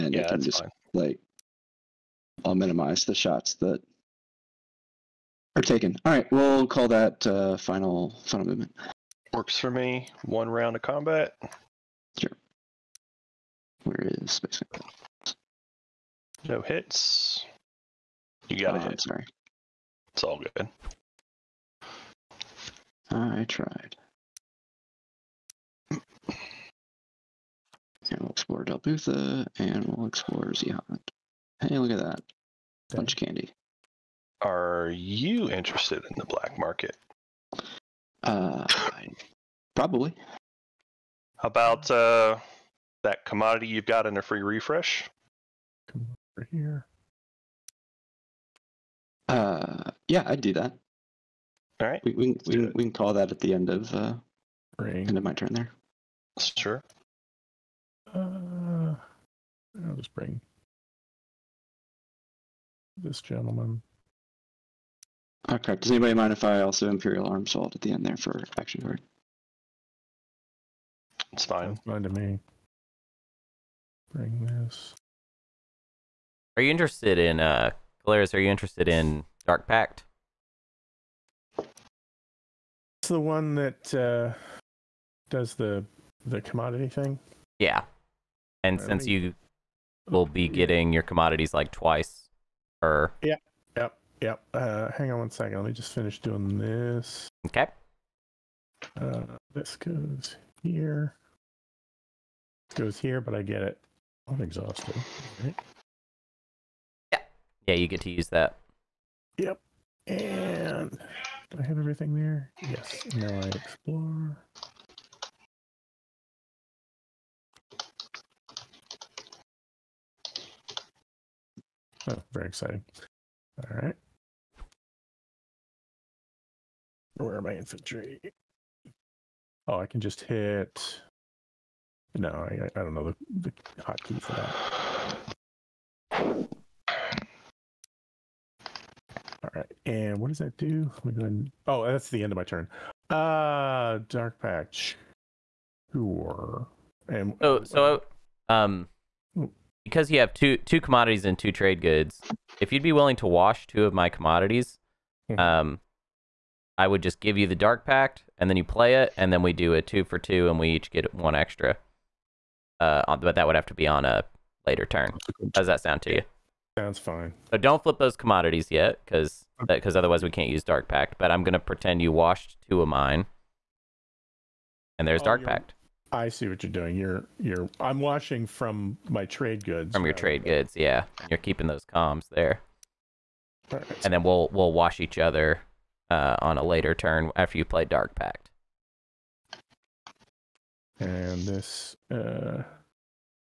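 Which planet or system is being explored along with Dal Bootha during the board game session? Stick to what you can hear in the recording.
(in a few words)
Xxehan.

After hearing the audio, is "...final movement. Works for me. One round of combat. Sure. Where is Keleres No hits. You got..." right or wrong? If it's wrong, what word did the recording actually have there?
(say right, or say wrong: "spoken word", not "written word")
wrong: "Space", not "Keleres".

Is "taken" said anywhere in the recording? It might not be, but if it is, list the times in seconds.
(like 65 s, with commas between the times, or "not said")
5 s.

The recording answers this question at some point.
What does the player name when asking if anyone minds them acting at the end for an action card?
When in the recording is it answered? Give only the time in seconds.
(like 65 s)
66 s.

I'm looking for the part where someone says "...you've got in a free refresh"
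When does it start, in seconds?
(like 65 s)
43 s.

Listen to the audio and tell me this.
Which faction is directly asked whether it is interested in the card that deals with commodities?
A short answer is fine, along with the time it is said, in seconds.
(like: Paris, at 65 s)
Keleres, at 78 s.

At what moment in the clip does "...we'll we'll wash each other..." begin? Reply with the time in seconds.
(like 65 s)
184 s.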